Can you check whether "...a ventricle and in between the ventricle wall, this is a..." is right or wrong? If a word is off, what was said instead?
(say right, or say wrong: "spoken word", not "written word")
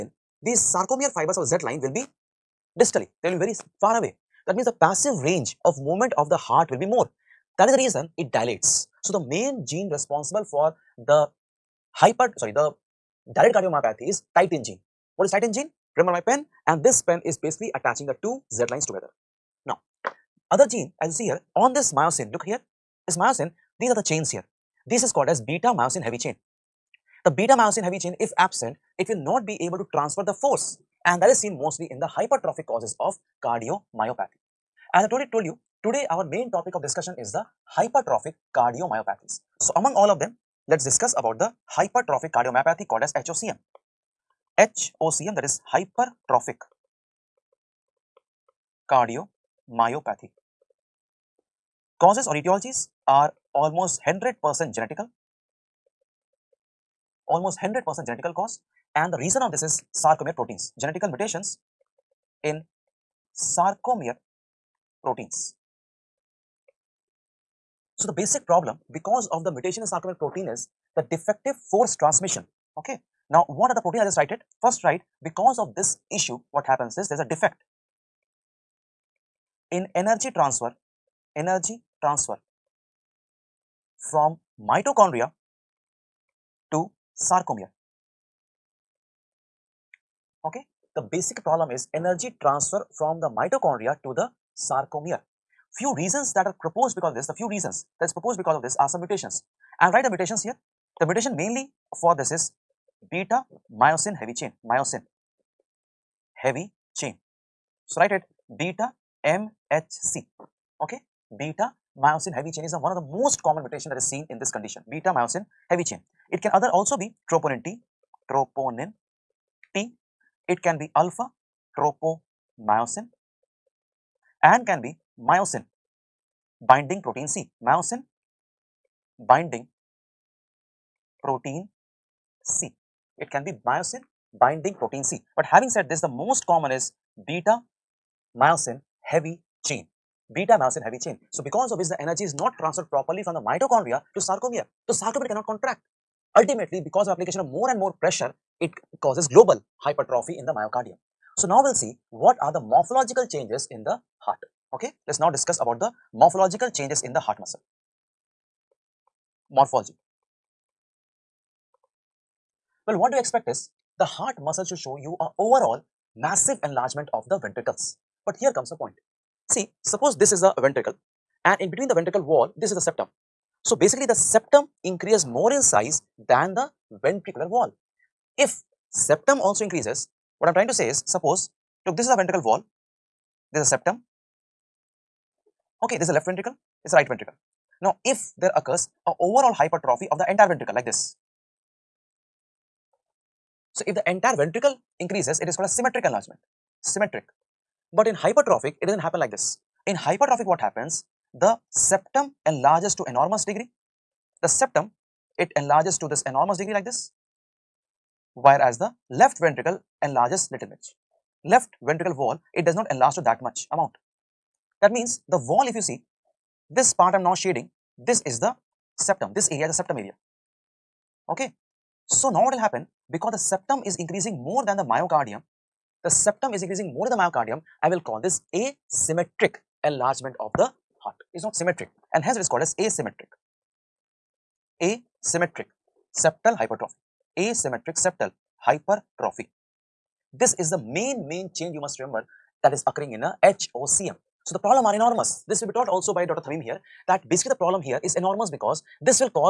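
right.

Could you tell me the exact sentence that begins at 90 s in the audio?
Okay, the basic problem is energy transfer from the mitochondria to the sarcomere.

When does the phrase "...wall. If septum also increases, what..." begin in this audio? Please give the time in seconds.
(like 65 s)
177 s.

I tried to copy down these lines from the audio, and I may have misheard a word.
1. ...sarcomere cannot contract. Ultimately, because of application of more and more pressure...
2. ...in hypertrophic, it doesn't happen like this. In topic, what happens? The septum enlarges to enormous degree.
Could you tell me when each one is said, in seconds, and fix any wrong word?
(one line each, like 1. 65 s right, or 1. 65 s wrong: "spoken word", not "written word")
1. 144 s right
2. 198 s wrong: "hypertrophic", not "topic".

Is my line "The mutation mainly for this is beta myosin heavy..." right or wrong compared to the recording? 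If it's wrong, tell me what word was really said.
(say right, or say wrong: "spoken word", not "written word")
right.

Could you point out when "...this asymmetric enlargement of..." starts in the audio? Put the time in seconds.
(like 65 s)
228 s.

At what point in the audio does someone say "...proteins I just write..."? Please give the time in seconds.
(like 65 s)
73 s.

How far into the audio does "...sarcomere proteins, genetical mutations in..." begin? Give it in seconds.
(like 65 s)
59 s.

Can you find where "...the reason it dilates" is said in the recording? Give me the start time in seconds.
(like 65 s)
7 s.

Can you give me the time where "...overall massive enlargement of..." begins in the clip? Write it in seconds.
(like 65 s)
165 s.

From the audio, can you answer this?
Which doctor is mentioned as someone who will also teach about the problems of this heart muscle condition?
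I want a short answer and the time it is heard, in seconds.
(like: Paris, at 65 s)
Dr. Thameem, at 246 s.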